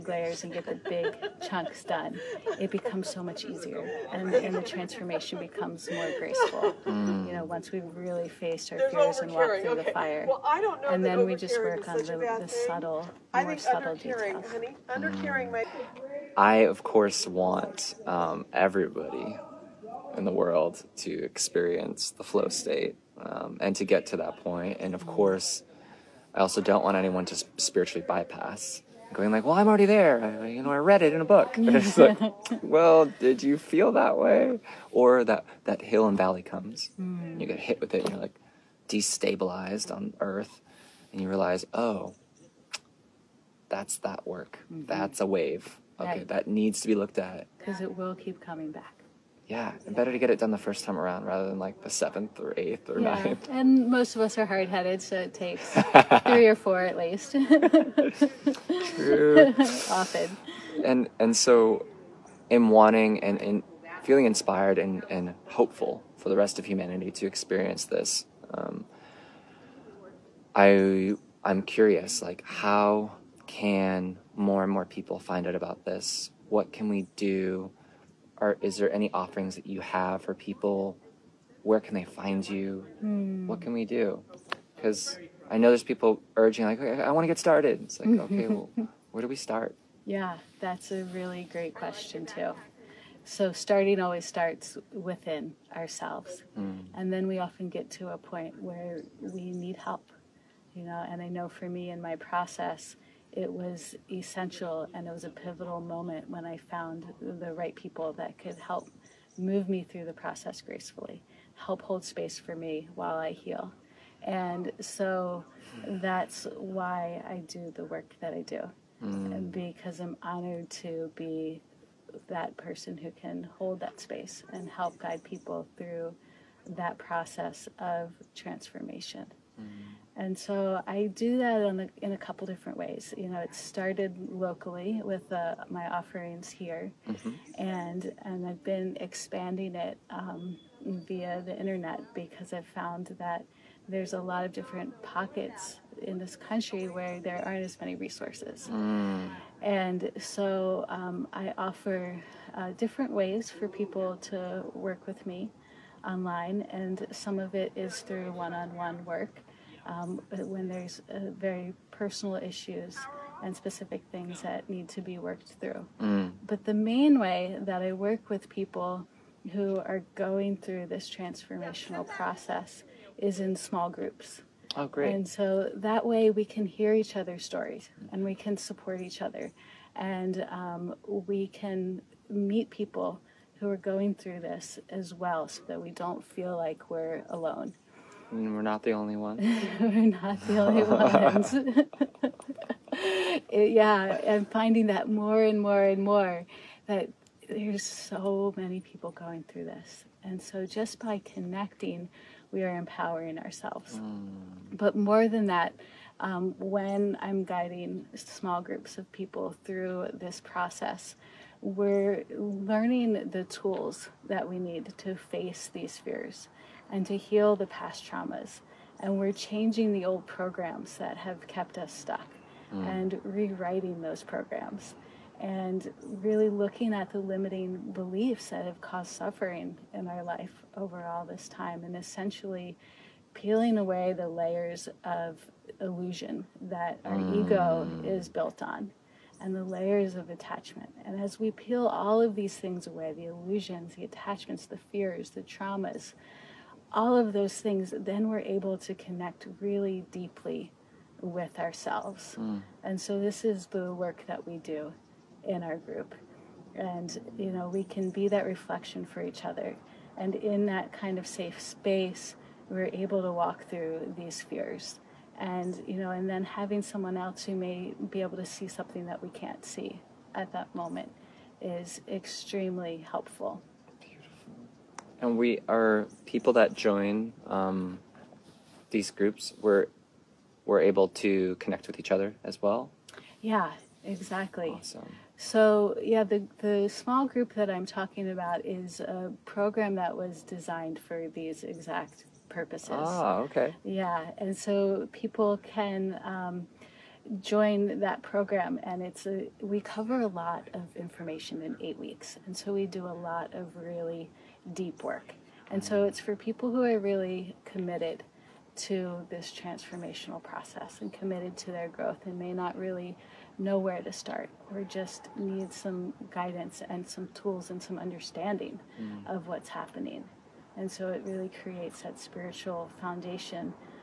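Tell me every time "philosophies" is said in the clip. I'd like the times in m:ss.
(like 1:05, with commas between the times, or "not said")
not said.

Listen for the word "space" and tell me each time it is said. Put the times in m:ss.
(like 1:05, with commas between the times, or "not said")
1:52, 2:03, 4:21.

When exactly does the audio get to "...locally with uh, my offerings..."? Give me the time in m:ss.
2:14.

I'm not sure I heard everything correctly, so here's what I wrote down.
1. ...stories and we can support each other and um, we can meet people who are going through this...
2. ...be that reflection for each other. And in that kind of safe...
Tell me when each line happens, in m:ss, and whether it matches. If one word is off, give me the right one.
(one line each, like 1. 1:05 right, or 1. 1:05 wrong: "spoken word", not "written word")
1. 2:57 right
2. 4:18 right.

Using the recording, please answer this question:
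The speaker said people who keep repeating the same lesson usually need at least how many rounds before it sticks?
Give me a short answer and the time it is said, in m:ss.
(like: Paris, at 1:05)
3 or 4, at 0:56.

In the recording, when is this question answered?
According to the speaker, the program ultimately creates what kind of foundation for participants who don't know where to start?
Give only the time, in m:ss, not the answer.
5:22.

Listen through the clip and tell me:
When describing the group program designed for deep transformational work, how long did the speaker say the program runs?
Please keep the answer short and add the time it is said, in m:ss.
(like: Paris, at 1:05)
8 weeks, at 5:01.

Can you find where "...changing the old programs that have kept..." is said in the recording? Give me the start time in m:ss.
3:39.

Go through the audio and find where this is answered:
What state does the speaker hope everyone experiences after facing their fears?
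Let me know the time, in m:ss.
0:22.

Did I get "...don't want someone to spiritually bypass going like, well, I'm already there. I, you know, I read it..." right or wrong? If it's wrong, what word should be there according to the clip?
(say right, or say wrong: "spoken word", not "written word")
wrong: "anyone", not "someone".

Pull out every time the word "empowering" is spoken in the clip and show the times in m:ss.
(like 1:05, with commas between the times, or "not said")
3:22.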